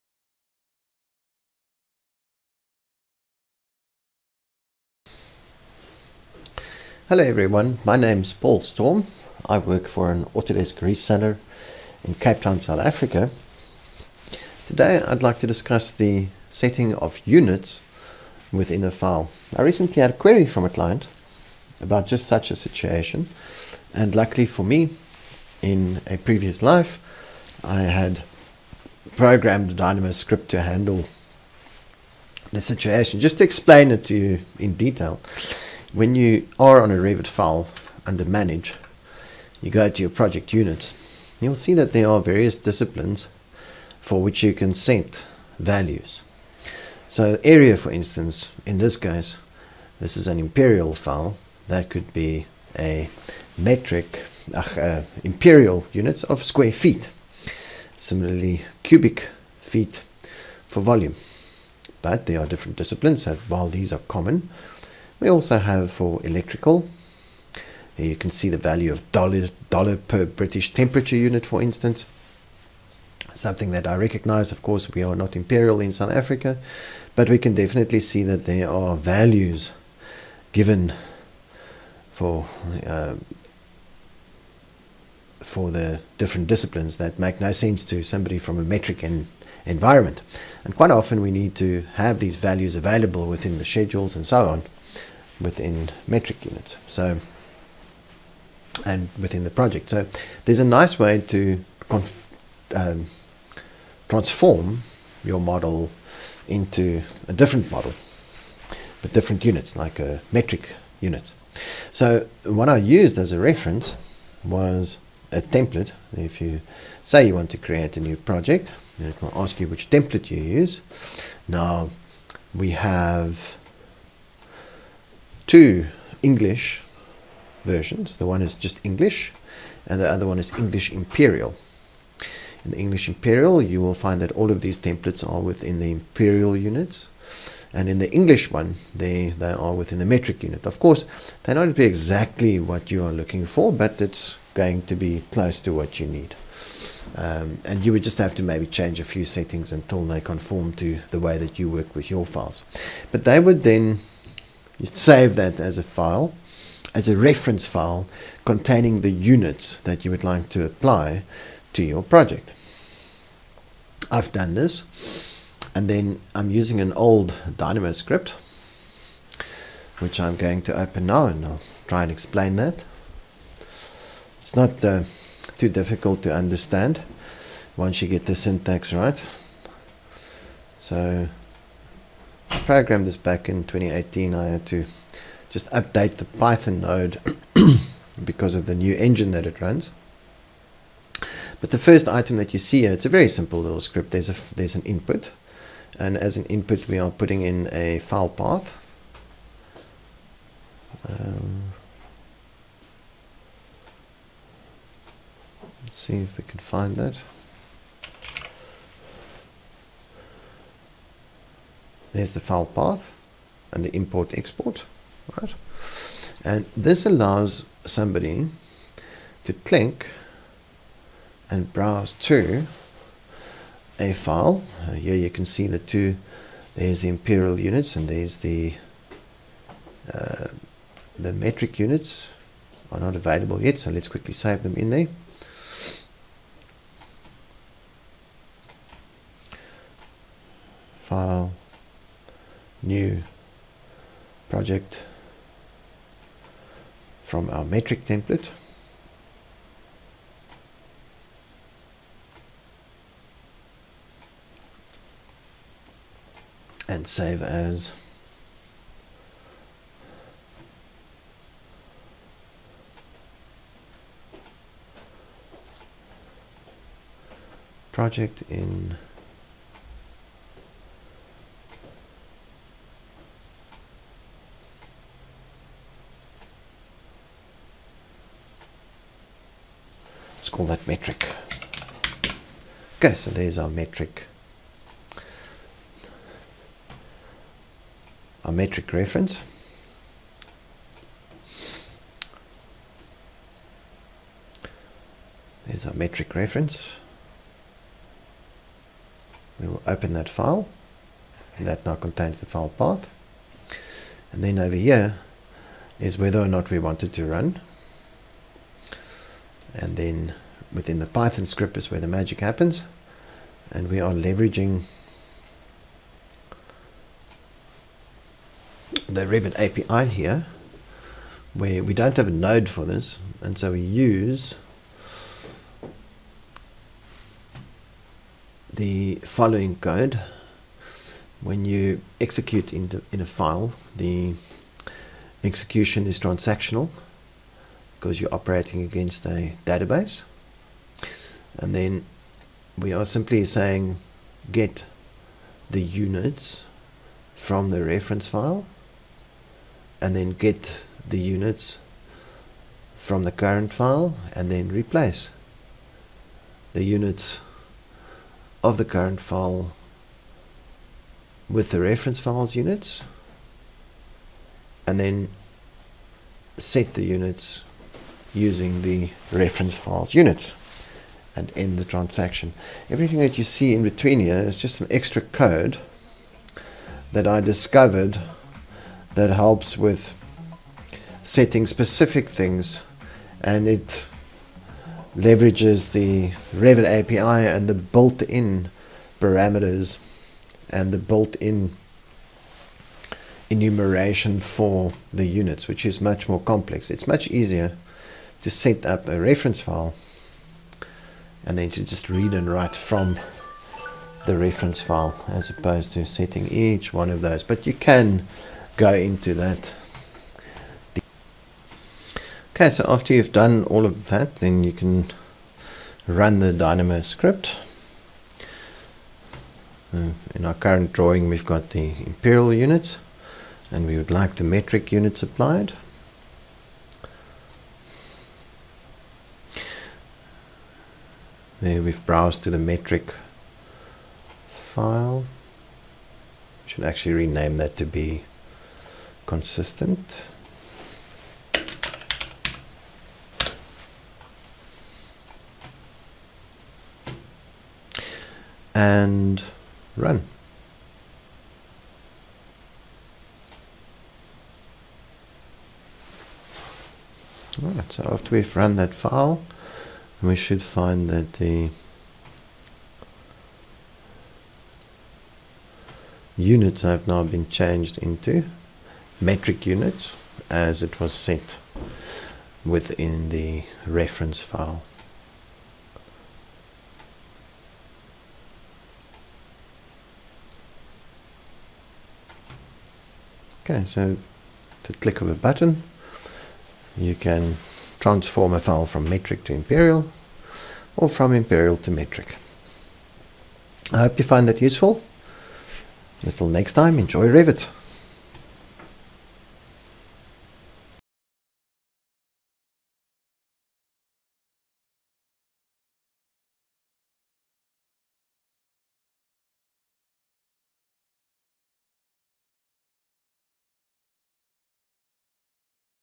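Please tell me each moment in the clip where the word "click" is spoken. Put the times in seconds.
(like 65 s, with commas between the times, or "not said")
219 s, 484 s.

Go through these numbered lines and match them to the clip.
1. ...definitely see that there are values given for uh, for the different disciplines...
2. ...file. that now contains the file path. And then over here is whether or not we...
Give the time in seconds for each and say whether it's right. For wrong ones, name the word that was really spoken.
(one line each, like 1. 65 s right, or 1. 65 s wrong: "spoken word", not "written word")
1. 77 s right
2. 300 s right.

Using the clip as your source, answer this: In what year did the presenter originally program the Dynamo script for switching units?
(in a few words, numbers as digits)
2018.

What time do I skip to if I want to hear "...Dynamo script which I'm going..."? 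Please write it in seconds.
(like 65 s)
167 s.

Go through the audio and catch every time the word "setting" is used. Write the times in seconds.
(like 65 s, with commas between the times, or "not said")
16 s, 149 s, 381 s, 406 s.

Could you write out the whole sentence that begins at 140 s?
Of course, they not be exactly what you are looking for, but it's going to be close to what you need.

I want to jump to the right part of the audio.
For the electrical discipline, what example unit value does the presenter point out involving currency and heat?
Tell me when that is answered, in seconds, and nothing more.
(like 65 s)
69 s.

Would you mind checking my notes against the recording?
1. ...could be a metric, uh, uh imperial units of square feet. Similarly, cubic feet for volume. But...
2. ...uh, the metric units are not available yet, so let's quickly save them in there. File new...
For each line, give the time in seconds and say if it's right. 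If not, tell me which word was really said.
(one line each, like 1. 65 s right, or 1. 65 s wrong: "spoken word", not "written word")
1. 51 s right
2. 230 s right.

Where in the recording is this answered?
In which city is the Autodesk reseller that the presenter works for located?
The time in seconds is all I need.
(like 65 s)
12 s.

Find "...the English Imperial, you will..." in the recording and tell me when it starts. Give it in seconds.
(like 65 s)
132 s.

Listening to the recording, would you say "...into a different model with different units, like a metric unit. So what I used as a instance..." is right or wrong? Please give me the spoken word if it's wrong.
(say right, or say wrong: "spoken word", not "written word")
wrong: "reference", not "instance".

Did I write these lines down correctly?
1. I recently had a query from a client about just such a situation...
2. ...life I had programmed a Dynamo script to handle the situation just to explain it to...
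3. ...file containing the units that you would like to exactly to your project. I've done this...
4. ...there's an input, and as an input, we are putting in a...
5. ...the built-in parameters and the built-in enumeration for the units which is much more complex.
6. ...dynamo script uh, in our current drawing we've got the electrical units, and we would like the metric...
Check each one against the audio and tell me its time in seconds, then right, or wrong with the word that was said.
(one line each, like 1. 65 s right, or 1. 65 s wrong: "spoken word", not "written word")
1. 19 s right
2. 26 s right
3. 157 s wrong: "apply", not "exactly"
4. 194 s right
5. 387 s right
6. 416 s wrong: "imperial", not "electrical".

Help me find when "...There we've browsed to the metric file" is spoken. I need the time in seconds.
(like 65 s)
431 s.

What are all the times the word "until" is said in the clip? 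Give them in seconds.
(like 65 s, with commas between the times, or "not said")
149 s, 496 s.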